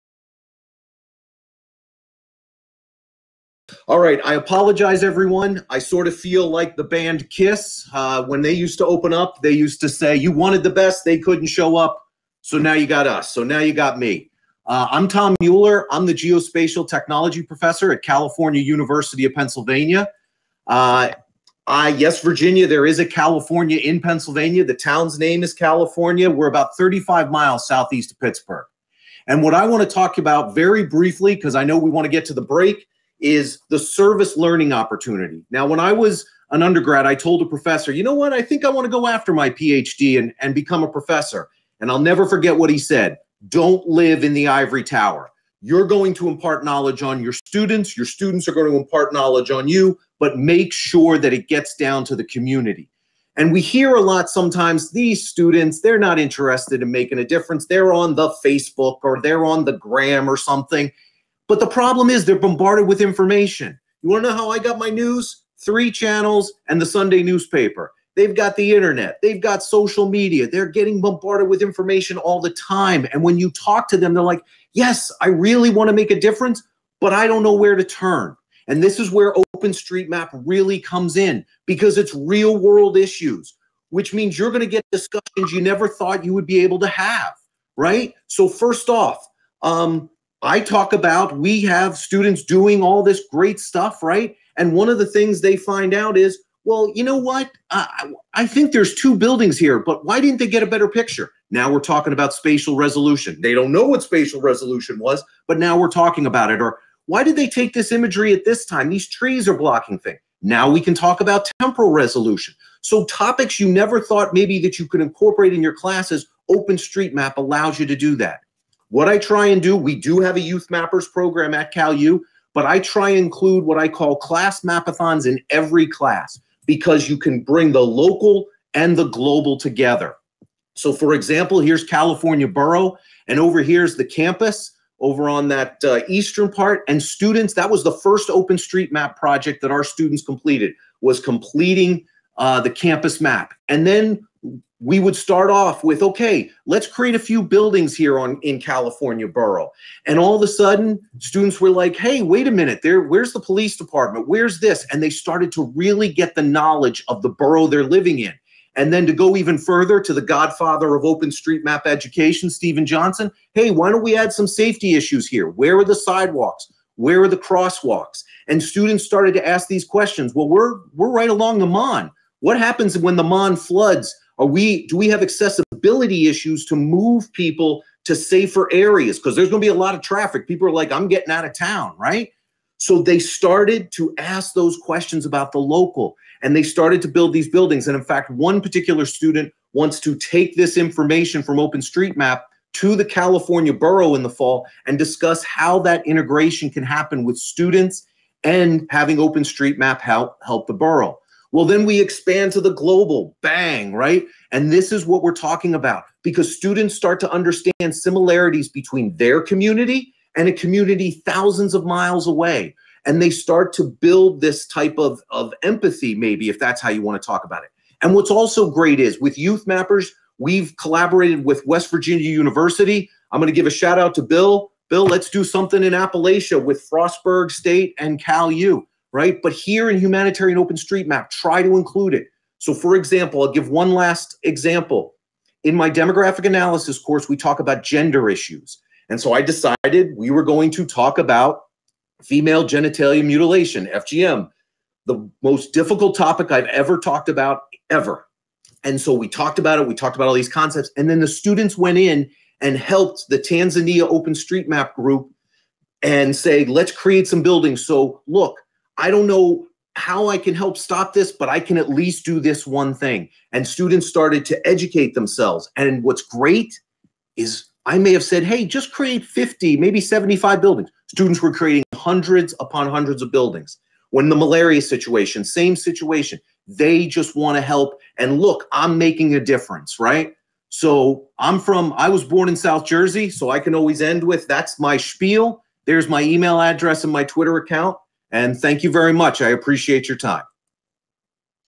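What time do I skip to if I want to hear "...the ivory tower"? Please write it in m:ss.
0:44.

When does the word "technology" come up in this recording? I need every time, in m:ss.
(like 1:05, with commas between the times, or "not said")
0:16.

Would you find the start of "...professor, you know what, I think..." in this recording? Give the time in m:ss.
0:37.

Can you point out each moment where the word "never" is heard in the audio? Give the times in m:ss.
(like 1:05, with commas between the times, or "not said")
0:41, 1:25, 1:53.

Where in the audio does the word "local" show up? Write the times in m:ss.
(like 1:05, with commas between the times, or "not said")
2:07, 3:05.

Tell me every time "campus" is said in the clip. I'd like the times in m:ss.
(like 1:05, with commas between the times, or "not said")
2:14, 2:22.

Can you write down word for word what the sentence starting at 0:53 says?
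And we hear a lot sometimes these students, they're not interested in making a difference.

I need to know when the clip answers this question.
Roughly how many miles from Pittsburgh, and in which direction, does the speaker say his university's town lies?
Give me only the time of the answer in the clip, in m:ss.
0:26.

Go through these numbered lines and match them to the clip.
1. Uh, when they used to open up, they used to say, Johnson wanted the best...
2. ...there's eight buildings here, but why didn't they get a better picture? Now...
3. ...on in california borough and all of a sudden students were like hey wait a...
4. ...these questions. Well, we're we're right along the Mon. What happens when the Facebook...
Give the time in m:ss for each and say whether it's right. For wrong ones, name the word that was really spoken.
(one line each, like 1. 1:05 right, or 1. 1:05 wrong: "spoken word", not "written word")
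1. 0:07 wrong: "You", not "Johnson"
2. 1:38 wrong: "two", not "eight"
3. 2:28 right
4. 2:49 wrong: "Mon", not "Facebook".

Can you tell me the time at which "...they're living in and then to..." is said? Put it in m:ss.
2:37.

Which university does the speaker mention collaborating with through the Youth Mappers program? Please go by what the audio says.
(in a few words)
West Virginia University.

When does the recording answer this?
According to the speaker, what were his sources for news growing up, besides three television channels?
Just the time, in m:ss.
1:06.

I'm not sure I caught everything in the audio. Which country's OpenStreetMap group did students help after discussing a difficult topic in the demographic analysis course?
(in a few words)
Tanzania.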